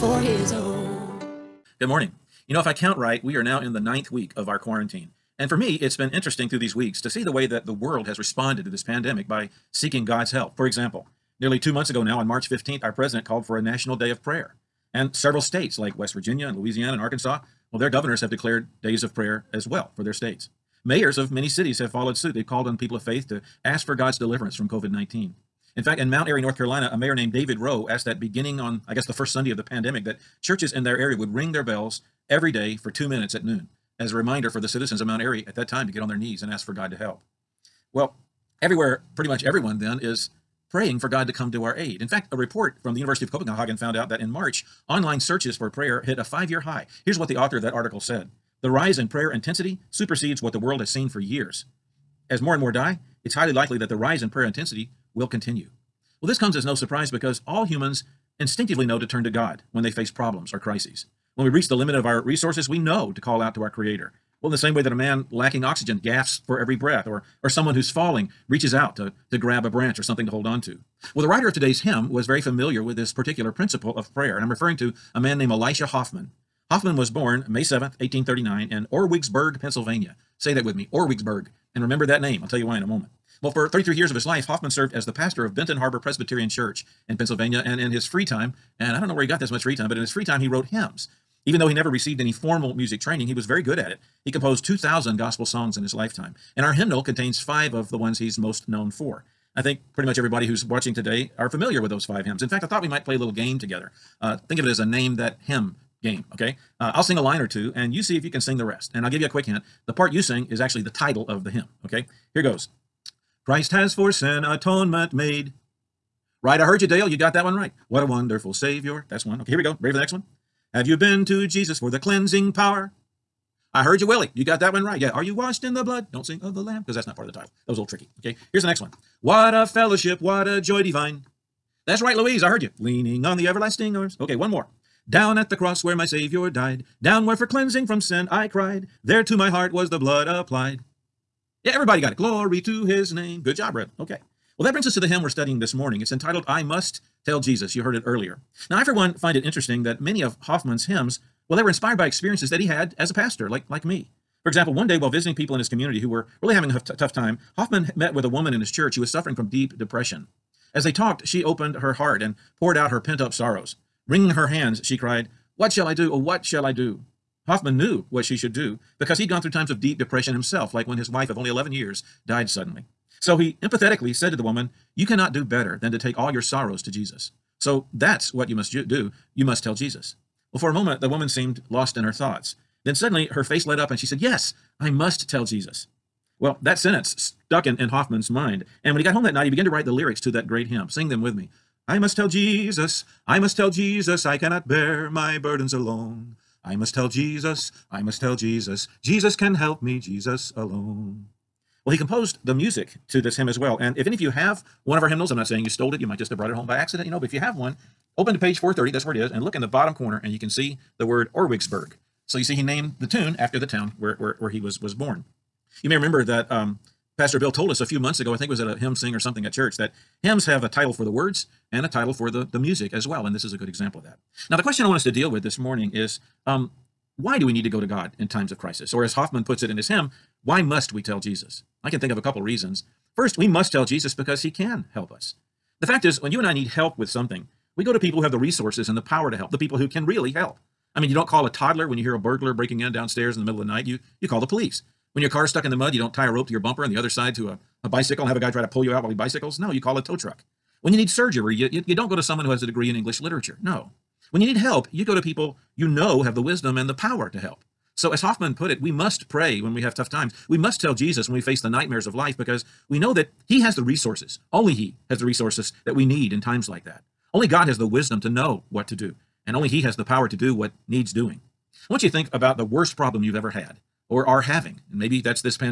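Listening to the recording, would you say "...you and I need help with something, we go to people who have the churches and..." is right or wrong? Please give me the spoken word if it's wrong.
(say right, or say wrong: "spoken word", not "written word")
wrong: "resources", not "churches".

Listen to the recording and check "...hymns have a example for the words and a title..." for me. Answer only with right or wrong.
wrong.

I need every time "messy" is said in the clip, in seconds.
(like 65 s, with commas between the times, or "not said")
not said.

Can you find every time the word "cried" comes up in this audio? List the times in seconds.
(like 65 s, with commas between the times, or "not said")
138 s, 164 s.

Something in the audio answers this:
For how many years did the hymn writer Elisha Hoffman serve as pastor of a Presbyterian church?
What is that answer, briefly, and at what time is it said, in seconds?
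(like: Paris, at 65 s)
33, at 83 s.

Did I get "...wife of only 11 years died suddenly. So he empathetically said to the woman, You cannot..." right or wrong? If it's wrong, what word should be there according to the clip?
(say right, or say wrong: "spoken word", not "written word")
right.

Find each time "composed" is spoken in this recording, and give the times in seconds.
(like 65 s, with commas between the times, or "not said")
94 s, 201 s.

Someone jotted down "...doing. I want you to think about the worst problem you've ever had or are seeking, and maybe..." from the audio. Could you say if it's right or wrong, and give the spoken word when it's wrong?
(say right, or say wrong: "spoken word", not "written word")
wrong: "having", not "seeking".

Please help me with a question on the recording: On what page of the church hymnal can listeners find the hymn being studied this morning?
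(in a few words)
430.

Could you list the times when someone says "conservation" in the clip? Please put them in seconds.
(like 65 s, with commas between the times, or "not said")
not said.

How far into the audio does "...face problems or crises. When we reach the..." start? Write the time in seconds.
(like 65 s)
59 s.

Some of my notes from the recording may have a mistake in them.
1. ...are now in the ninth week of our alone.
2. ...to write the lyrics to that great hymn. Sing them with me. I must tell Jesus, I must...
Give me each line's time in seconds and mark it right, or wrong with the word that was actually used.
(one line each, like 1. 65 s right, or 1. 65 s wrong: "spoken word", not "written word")
1. 3 s wrong: "quarantine", not "alone"
2. 189 s right.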